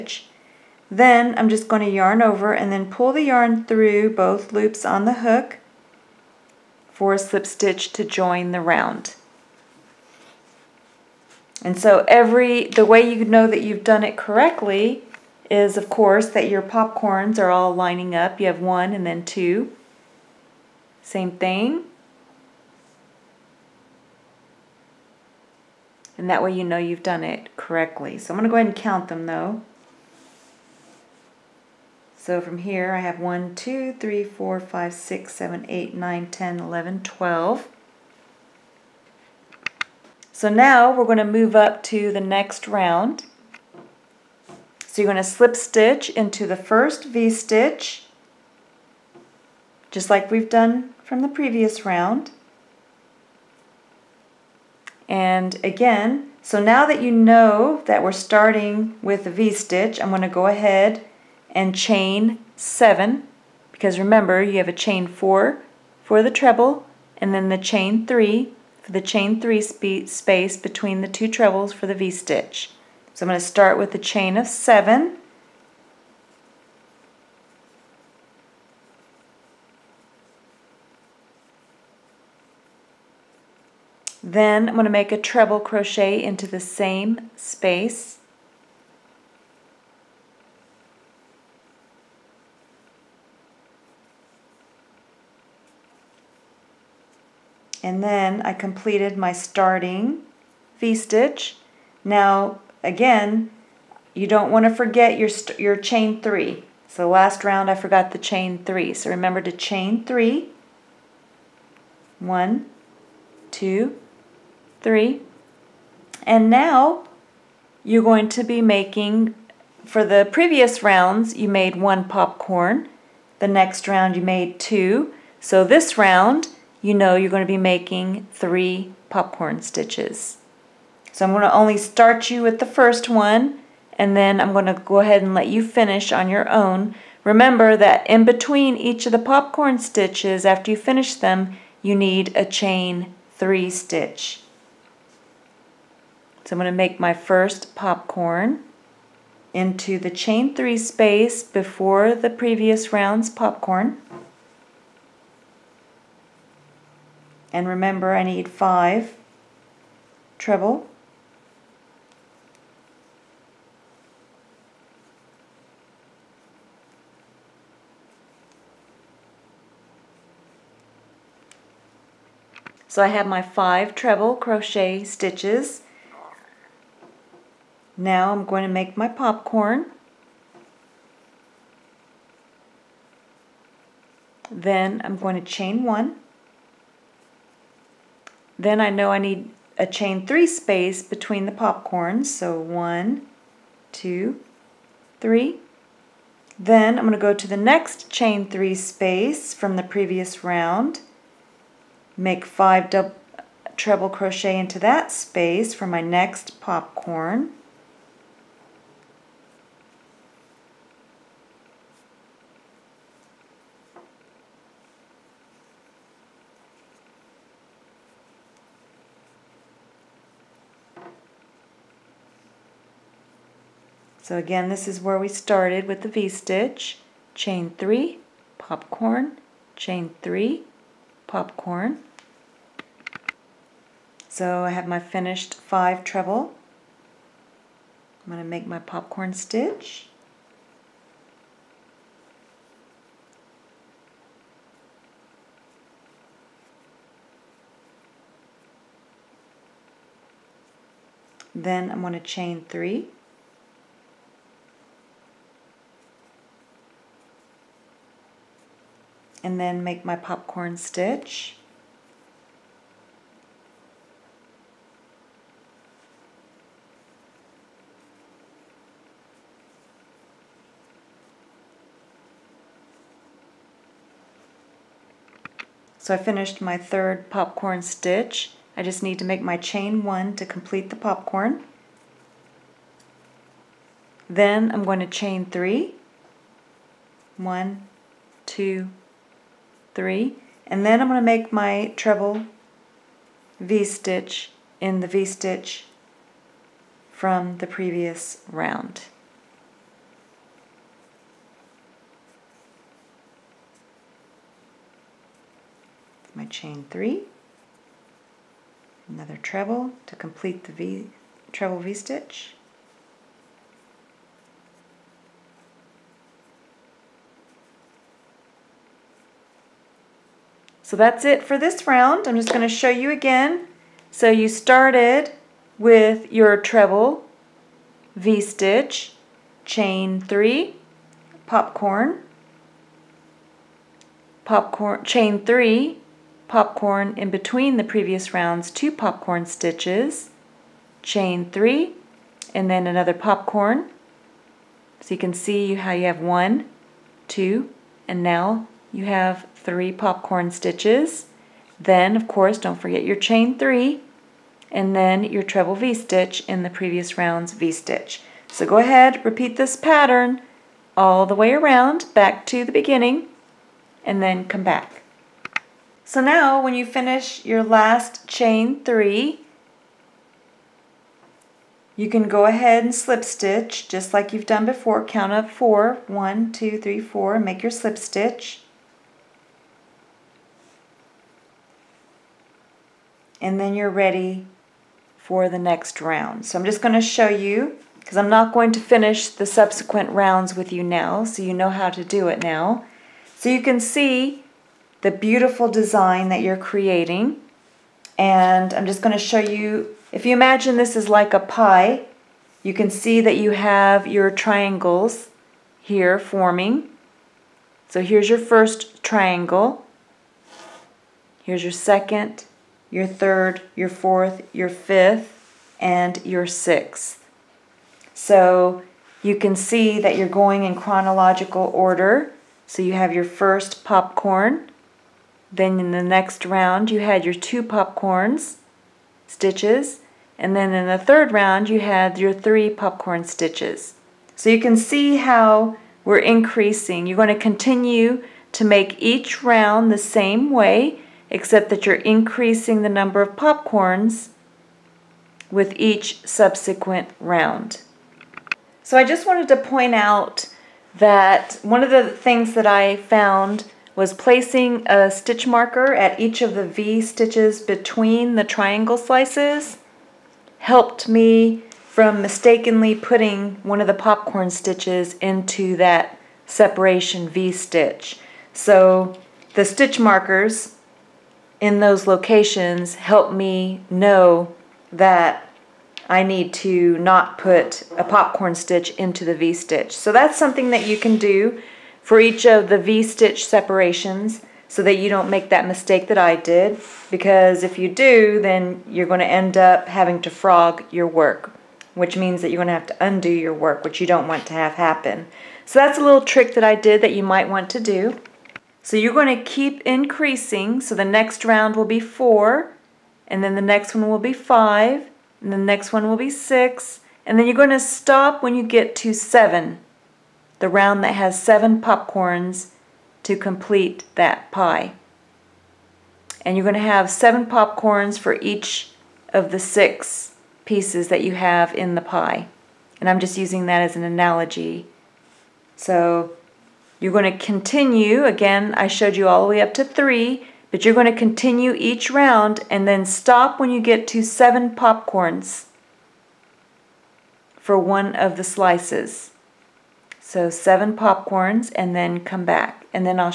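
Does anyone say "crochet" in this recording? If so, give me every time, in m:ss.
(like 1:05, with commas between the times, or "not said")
1:25, 2:54, 3:24.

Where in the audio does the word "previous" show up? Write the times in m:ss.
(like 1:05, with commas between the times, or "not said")
0:51, 2:00, 2:32, 3:19, 4:57, 5:37, 5:56.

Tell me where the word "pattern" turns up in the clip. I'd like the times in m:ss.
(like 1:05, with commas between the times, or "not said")
5:59.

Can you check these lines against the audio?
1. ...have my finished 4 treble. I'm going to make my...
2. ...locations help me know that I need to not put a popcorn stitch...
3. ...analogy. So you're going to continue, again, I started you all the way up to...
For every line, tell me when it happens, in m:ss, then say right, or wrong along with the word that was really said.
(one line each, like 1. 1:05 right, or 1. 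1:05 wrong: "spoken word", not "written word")
1. 3:54 wrong: "5", not "4"
2. 7:52 right
3. 8:44 wrong: "showed", not "started".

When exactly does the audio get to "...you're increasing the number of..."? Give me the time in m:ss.
7:21.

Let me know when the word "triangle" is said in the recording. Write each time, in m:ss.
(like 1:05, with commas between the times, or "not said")
6:44, 6:49, 7:38.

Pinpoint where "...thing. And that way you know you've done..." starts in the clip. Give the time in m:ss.
0:21.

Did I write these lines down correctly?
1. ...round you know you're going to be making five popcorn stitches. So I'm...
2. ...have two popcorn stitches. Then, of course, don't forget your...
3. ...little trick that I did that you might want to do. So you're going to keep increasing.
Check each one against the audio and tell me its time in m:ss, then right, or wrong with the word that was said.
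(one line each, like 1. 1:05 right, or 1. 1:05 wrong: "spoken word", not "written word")
1. 2:05 wrong: "three", not "five"
2. 5:49 wrong: "three", not "two"
3. 8:16 right.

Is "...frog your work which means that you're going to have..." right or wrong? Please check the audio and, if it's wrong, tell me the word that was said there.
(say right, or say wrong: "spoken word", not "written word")
right.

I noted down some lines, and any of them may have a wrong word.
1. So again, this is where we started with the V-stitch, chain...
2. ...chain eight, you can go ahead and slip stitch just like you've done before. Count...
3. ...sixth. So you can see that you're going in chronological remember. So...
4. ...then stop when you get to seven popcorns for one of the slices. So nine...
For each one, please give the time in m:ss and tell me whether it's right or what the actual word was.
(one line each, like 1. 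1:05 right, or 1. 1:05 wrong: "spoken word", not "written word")
1. 3:44 right
2. 6:08 wrong: "three", not "eight"
3. 6:56 wrong: "order", not "remember"
4. 8:52 wrong: "seven", not "nine".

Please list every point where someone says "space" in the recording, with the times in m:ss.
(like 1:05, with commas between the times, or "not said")
1:10, 1:27, 2:30, 3:10, 3:18, 3:25.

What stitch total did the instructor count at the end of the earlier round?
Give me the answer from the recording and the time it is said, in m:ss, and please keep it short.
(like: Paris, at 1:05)
12, at 0:37.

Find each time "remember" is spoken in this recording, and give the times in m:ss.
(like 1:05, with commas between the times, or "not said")
1:03, 1:49, 2:17, 2:37.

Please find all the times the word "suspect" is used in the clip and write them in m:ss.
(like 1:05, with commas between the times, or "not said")
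not said.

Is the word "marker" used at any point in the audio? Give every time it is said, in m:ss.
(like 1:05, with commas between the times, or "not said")
7:35, 7:49.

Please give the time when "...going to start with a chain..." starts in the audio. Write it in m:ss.
1:13.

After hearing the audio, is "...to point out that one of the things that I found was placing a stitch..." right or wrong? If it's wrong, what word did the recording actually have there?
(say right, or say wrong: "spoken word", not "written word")
right.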